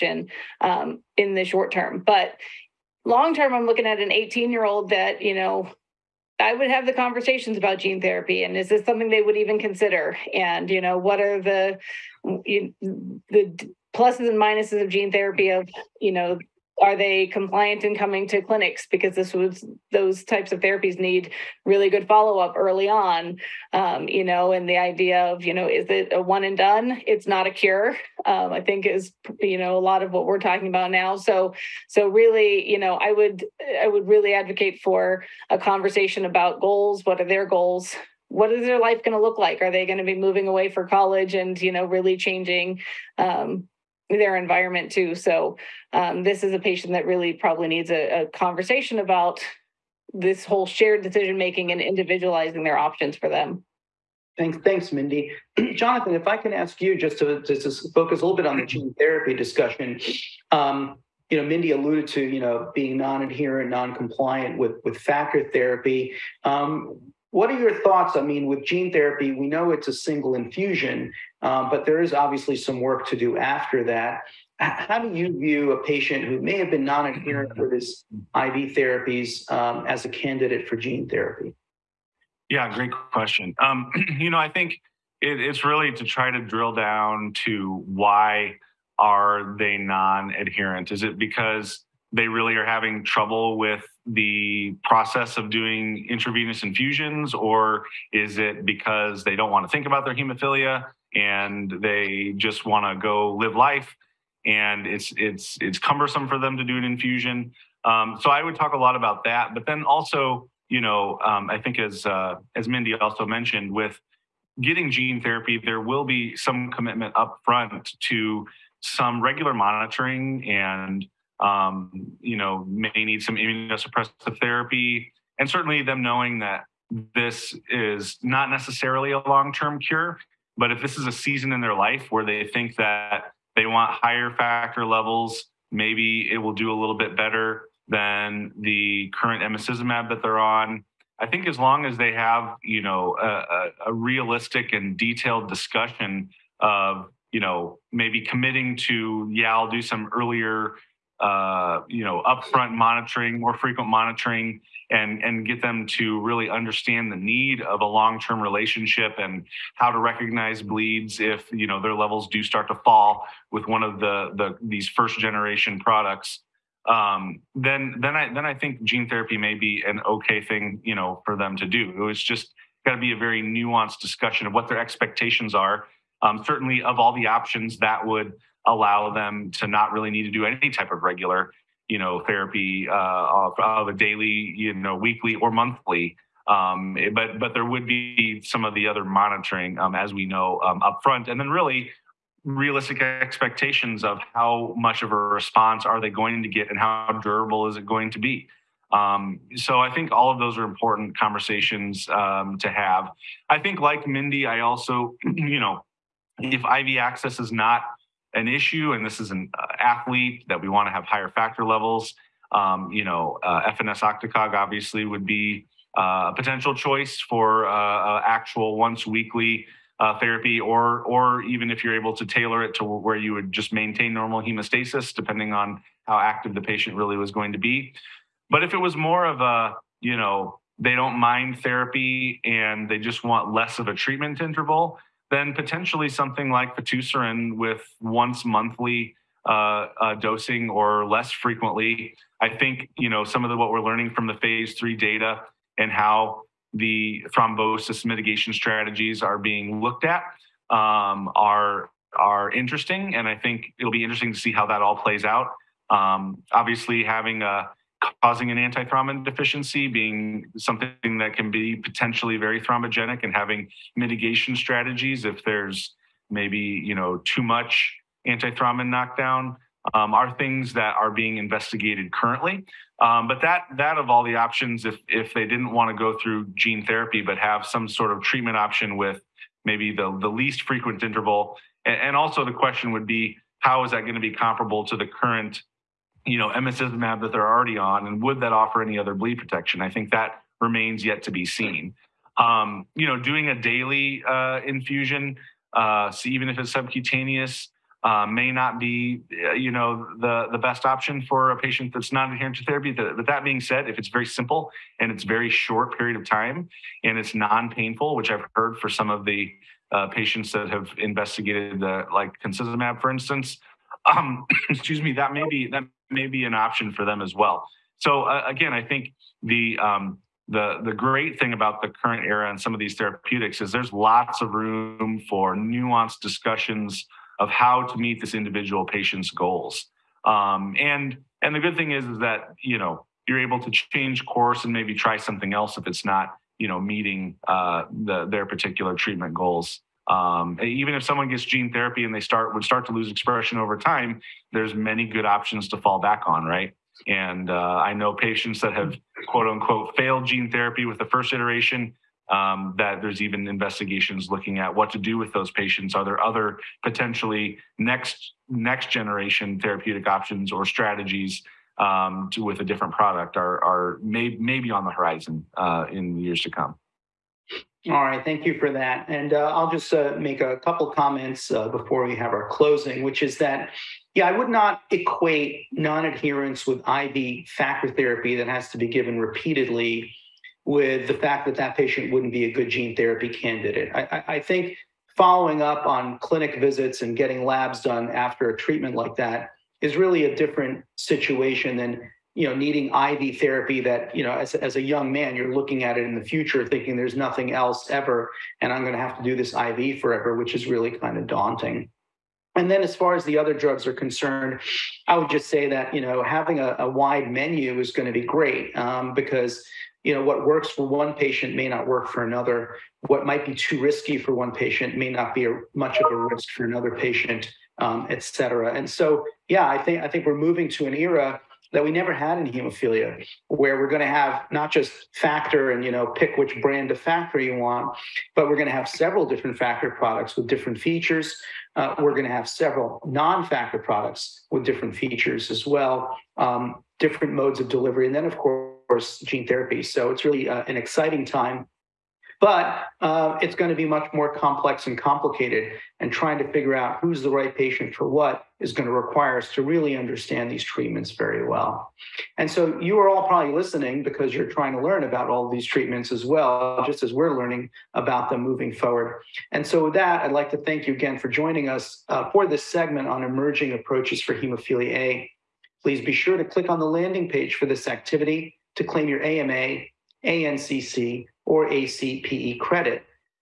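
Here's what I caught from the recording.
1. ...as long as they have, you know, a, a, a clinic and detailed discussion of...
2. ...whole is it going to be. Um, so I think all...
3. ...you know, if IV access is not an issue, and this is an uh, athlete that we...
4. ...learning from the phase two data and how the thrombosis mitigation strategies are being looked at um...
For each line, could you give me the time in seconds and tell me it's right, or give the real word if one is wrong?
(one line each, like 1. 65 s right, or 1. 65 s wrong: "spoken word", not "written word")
1. 141 s wrong: "realistic", not "clinic"
2. 197 s wrong: "durable", not "whole"
3. 205 s right
4. 243 s wrong: "three", not "two".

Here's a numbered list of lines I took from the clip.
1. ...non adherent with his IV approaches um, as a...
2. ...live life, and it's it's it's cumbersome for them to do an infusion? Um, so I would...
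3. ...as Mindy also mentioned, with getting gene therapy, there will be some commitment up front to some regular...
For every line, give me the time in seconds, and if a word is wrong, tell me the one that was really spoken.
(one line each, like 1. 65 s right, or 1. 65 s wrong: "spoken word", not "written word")
1. 76 s wrong: "therapies", not "approaches"
2. 103 s right
3. 112 s right.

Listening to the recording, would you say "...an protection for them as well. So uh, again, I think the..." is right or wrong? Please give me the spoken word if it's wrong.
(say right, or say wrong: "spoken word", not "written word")
wrong: "option", not "protection".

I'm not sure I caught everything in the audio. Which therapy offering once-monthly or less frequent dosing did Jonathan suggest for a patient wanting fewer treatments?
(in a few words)
fitusiran.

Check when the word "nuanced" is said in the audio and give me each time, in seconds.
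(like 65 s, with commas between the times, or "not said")
173 s, 325 s.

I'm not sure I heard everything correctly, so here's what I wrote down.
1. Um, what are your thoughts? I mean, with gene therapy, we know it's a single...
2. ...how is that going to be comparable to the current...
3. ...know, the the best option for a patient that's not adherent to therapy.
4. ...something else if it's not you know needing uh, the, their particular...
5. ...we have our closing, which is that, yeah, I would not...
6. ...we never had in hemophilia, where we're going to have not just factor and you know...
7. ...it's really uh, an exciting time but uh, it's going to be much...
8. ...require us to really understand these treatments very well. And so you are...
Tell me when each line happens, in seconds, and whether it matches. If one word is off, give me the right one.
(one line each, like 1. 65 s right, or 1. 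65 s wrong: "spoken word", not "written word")
1. 66 s right
2. 283 s right
3. 299 s right
4. 335 s wrong: "meeting", not "needing"
5. 372 s right
6. 421 s right
7. 440 s right
8. 448 s right.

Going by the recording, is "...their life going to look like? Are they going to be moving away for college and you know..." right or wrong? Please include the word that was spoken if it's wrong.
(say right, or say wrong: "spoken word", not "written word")
right.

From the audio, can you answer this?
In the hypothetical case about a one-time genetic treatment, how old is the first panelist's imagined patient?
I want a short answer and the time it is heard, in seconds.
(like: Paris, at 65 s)
18, at 4 s.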